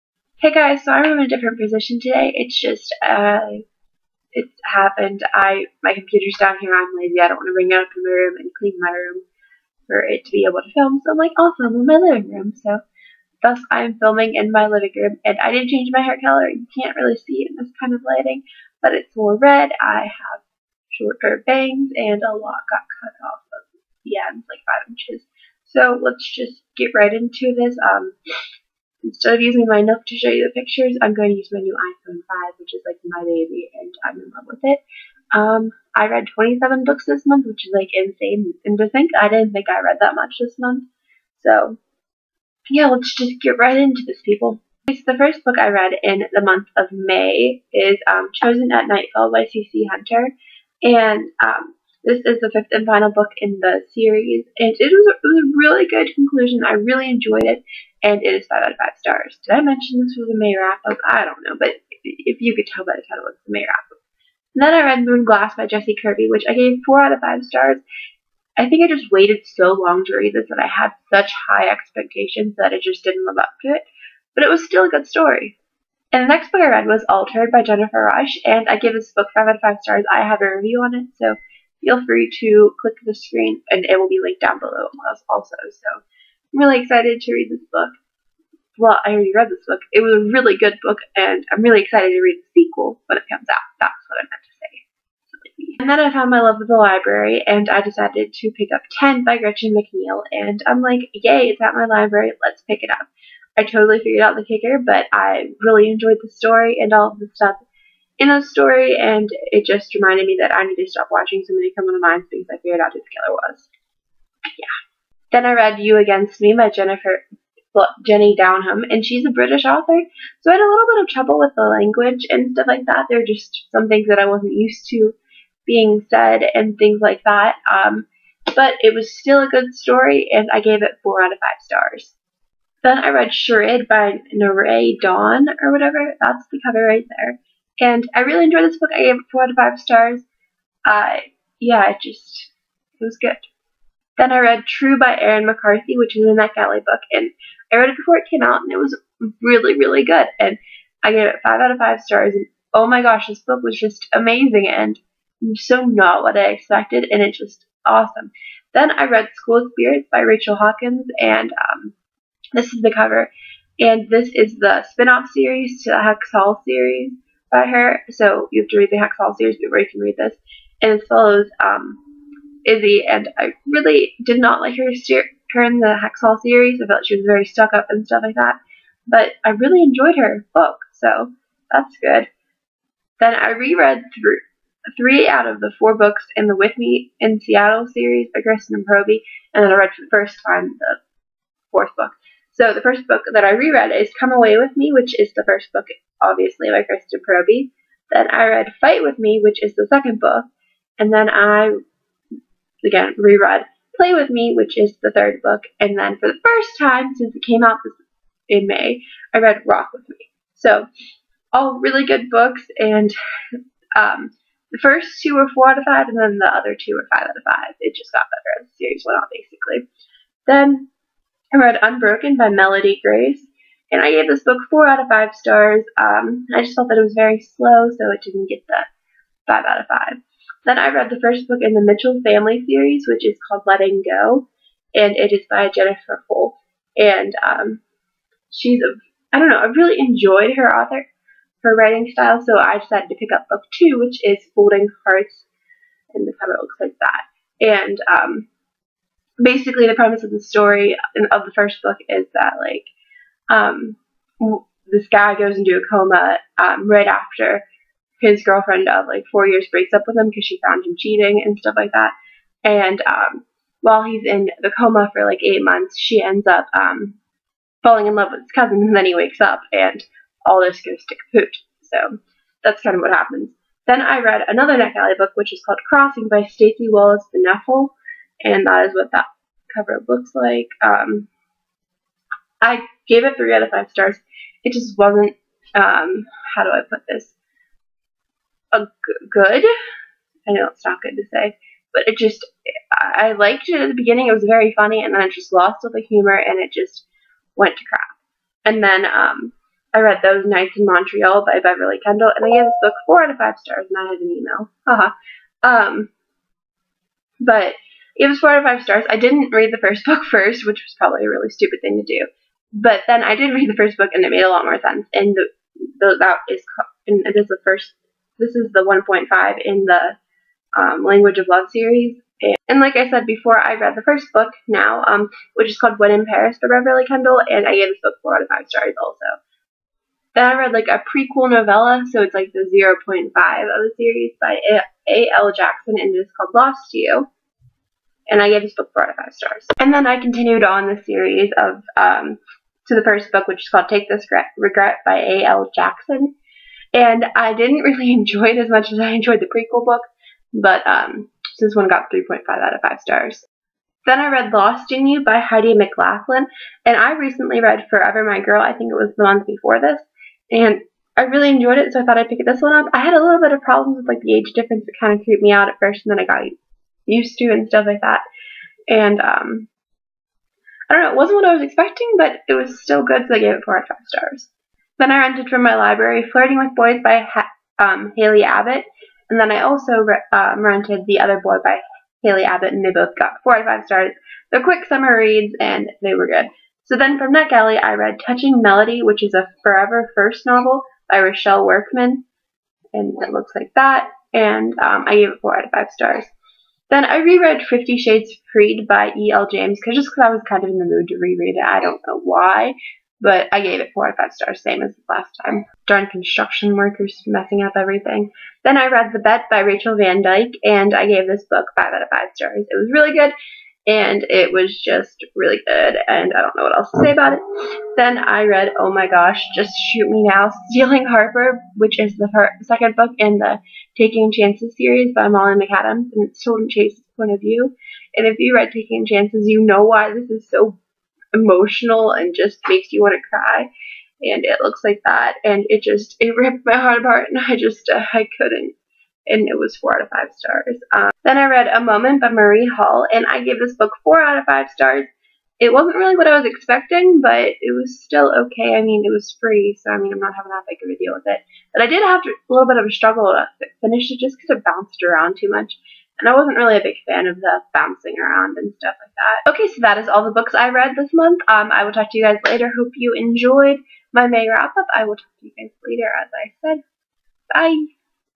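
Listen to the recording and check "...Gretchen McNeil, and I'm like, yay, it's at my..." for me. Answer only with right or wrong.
right.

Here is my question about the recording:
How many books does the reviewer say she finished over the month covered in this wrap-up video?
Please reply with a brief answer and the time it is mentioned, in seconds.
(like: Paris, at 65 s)
27, at 36 s.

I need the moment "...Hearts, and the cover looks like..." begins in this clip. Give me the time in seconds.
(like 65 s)
245 s.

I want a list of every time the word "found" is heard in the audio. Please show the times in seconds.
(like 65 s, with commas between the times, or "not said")
96 s, 260 s.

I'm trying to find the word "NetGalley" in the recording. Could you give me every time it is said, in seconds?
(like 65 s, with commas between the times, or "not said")
146 s, 274 s, 387 s.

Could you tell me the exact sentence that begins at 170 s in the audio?
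And it follows um, Izzy, and I really did not like her steer- her in the Hex Hall series.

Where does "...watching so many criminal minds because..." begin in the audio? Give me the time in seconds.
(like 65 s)
111 s.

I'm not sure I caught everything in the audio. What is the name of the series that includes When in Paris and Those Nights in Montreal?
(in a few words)
Language of Love.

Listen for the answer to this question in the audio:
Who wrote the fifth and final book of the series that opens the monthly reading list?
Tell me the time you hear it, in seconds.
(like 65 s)
49 s.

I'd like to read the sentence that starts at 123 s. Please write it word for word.
There are just some things that I wasn't used to being said and things like that.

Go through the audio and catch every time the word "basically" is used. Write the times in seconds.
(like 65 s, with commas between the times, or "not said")
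219 s, 249 s.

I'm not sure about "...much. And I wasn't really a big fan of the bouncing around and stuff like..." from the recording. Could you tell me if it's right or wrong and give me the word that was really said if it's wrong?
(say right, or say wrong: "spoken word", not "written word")
right.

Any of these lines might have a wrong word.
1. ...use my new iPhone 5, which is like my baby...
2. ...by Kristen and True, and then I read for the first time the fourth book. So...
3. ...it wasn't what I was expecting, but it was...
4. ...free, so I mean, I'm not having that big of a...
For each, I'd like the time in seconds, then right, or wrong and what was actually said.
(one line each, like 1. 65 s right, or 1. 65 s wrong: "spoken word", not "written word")
1. 31 s right
2. 188 s wrong: "Proby", not "True"
3. 371 s right
4. 449 s right.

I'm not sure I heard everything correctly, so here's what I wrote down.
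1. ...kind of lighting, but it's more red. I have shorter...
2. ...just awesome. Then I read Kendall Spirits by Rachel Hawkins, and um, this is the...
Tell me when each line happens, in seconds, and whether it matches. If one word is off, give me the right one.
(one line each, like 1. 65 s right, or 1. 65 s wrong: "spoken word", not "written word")
1. 17 s right
2. 157 s wrong: "School", not "Kendall".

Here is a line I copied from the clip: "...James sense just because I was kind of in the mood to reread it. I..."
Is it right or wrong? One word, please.
wrong.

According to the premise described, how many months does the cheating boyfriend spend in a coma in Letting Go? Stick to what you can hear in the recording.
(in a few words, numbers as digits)
8.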